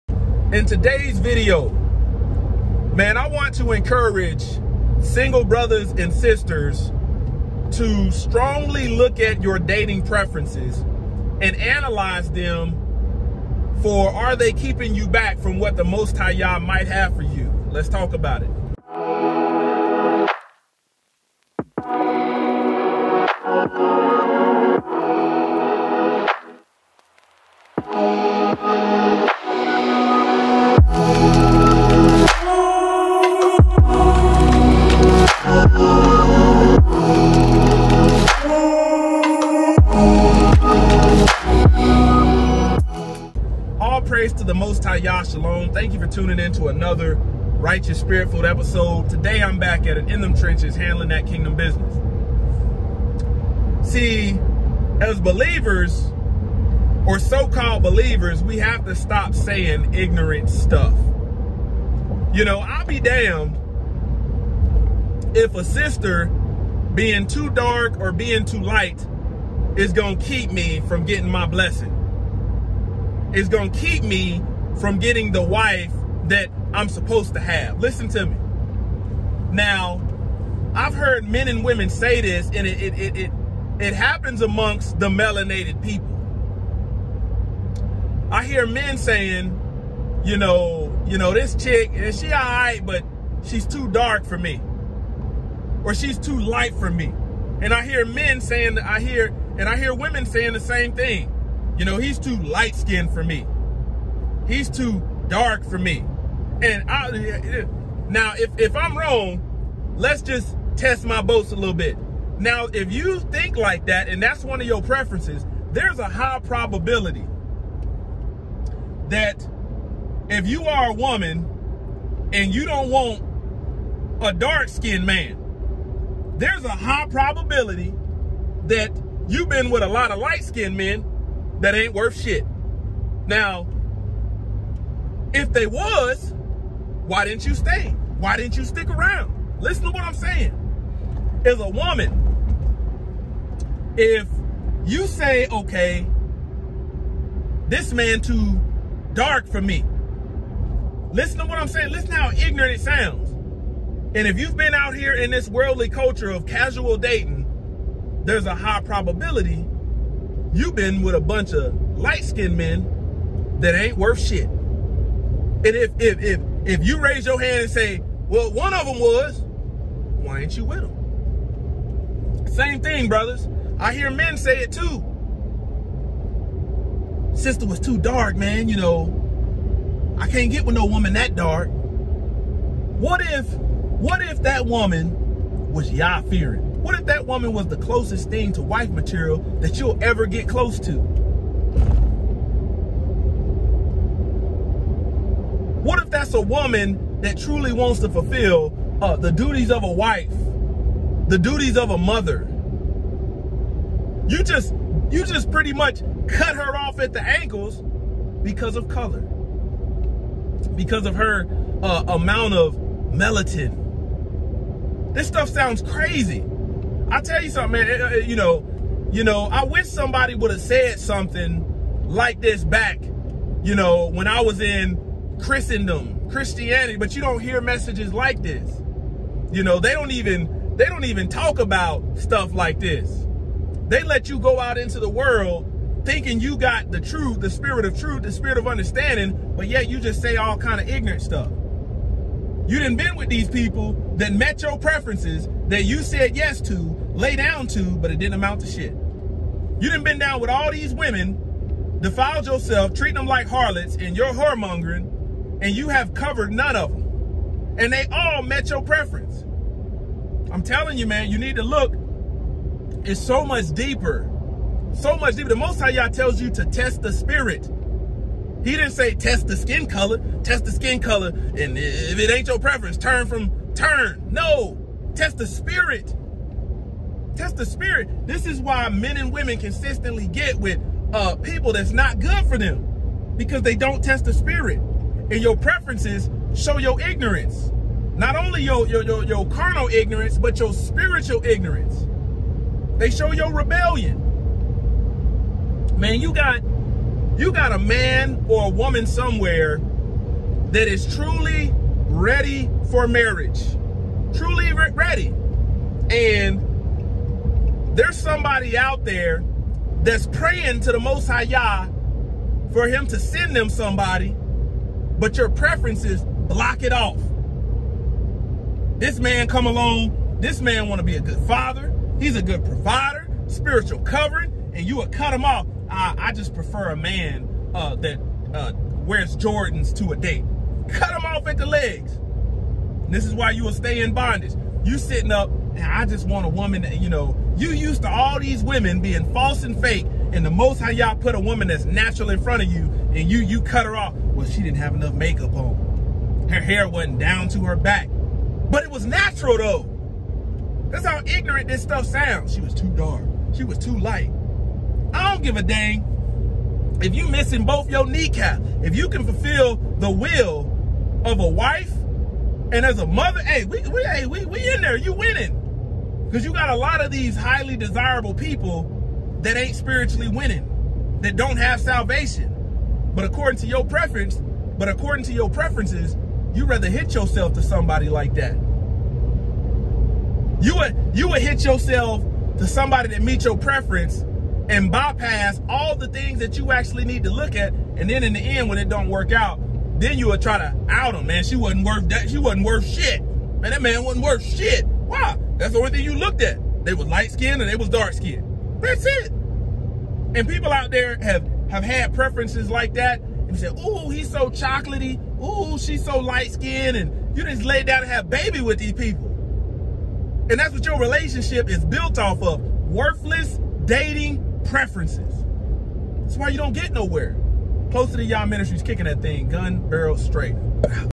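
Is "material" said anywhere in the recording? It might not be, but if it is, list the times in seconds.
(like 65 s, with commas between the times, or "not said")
188 s.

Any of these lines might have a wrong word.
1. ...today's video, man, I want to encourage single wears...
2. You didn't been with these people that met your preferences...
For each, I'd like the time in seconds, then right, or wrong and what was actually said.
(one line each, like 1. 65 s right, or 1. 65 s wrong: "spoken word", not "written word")
1. 0 s wrong: "brothers", not "wears"
2. 242 s right.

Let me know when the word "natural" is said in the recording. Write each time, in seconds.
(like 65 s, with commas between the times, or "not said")
341 s, 349 s.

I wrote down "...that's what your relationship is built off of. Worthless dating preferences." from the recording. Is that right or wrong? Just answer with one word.
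right.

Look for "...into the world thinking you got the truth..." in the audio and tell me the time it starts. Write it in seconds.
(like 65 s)
234 s.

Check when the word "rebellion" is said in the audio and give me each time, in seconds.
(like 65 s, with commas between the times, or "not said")
293 s.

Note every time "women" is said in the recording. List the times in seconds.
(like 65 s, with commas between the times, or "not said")
81 s, 99 s, 250 s, 279 s, 338 s.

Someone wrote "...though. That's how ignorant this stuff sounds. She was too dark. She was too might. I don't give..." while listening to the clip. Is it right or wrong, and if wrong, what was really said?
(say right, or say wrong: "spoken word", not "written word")
wrong: "light", not "might".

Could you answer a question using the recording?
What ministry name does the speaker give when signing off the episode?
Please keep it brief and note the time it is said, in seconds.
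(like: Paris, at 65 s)
Close to the Yah Ministries, at 417 s.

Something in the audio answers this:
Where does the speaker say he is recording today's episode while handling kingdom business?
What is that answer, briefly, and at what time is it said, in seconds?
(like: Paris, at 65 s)
In Them Trenches, at 50 s.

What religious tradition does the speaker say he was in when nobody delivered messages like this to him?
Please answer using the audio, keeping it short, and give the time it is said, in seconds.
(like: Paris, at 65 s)
Christendom, at 225 s.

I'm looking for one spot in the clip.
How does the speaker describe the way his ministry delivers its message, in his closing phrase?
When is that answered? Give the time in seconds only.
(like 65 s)
419 s.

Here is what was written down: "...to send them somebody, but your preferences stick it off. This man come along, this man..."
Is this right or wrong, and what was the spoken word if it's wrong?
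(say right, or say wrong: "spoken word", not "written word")
wrong: "block", not "stick".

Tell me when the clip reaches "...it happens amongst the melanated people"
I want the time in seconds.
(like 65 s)
83 s.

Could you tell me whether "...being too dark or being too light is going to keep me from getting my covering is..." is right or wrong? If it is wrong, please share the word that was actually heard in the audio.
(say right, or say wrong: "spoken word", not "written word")
wrong: "blessing", not "covering".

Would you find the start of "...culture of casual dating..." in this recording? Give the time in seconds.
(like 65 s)
155 s.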